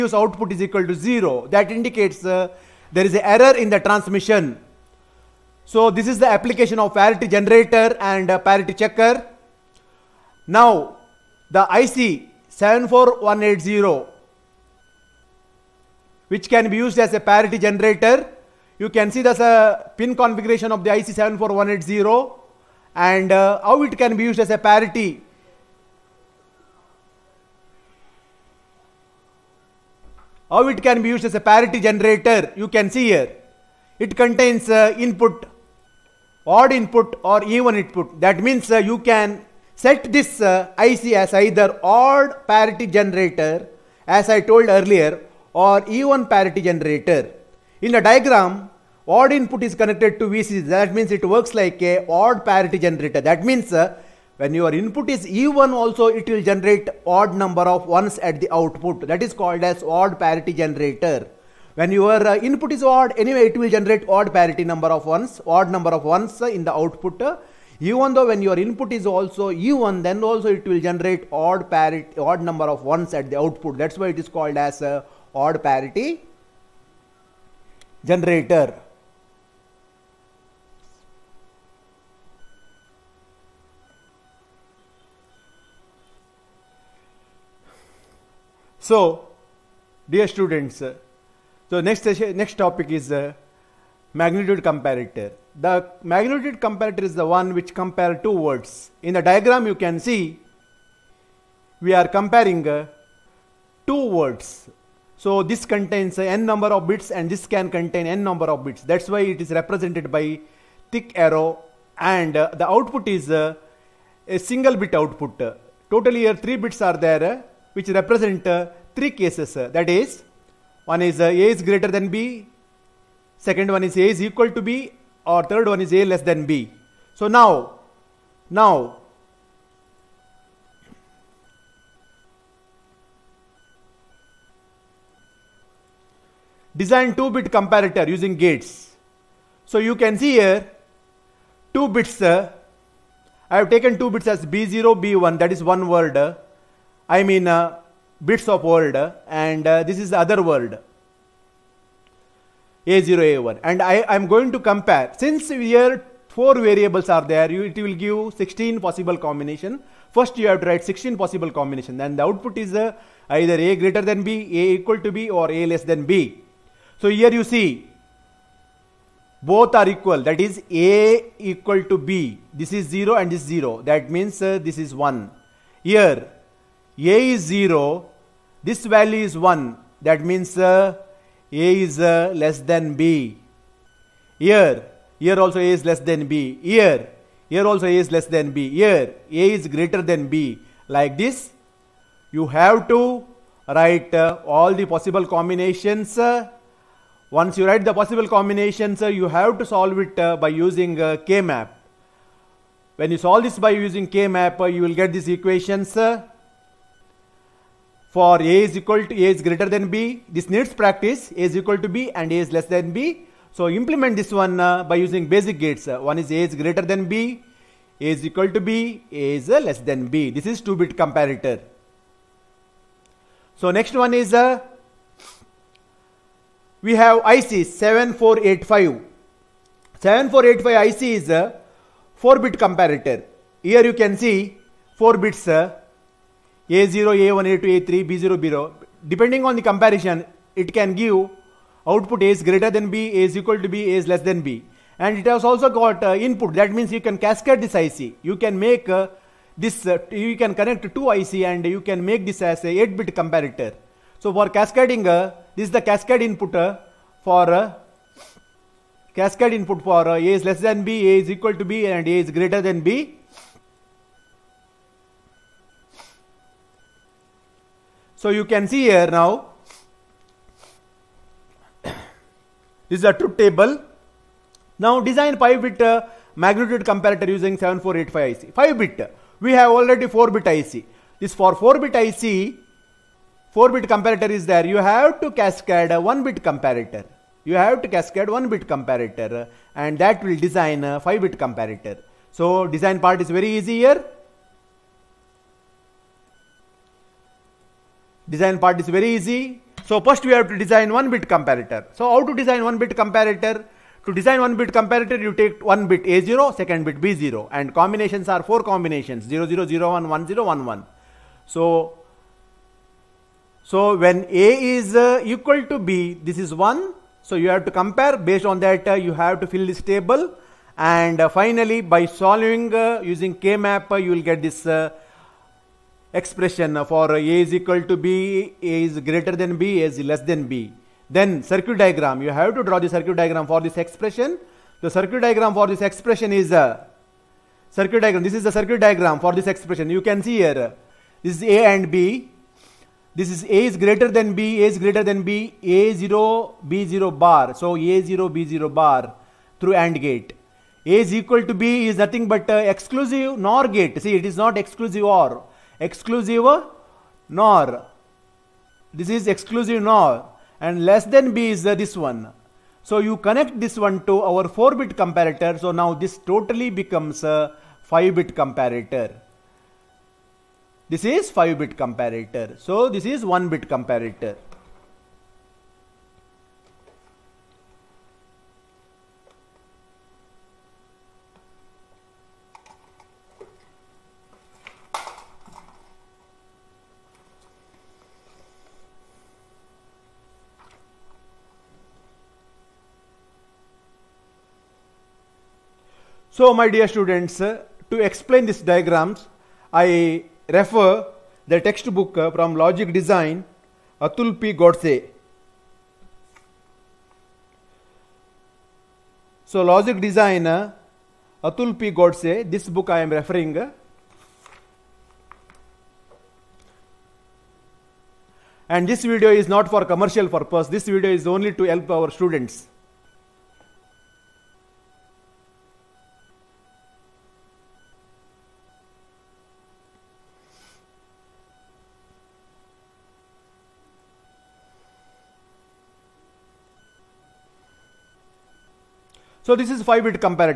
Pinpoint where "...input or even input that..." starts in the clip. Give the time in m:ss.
0:36.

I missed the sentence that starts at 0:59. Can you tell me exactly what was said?
That is called as odd parity generator.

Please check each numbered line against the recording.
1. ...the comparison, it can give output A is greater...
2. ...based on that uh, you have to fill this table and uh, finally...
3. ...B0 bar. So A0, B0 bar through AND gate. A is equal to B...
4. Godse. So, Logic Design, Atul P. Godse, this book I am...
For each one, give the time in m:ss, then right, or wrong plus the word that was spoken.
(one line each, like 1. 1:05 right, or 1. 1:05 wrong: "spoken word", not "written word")
1. 3:59 right
2. 5:18 right
3. 5:46 right
4. 6:44 right.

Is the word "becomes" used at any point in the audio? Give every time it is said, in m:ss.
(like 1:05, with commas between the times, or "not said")
6:06.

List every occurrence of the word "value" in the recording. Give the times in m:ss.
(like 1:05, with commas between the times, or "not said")
2:58.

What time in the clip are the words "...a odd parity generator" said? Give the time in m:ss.
0:51.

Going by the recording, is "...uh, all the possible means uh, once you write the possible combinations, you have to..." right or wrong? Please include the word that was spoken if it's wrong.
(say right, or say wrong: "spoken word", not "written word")
wrong: "combinations", not "means".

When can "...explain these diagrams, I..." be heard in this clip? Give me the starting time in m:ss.
6:37.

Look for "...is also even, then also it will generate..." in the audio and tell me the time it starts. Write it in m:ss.
1:08.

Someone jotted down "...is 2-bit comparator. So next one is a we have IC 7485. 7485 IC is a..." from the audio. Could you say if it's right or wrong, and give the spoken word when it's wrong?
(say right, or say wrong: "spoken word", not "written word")
right.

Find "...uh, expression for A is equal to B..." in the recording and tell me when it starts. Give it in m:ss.
5:24.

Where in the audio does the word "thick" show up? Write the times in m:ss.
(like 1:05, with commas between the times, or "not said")
1:50.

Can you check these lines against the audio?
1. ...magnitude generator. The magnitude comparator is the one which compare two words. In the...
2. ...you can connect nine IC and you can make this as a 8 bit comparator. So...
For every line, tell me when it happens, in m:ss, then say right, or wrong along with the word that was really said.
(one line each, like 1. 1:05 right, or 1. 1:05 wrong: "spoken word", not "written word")
1. 1:34 wrong: "comparator", not "generator"
2. 4:10 wrong: "two", not "nine".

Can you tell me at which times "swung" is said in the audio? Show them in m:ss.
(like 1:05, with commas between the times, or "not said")
not said.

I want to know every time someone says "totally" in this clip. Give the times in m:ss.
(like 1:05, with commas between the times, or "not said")
1:55, 6:06.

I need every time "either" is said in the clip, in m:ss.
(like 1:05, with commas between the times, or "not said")
0:41, 2:43.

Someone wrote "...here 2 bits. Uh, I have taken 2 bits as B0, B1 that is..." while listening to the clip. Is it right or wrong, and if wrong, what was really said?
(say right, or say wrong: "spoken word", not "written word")
right.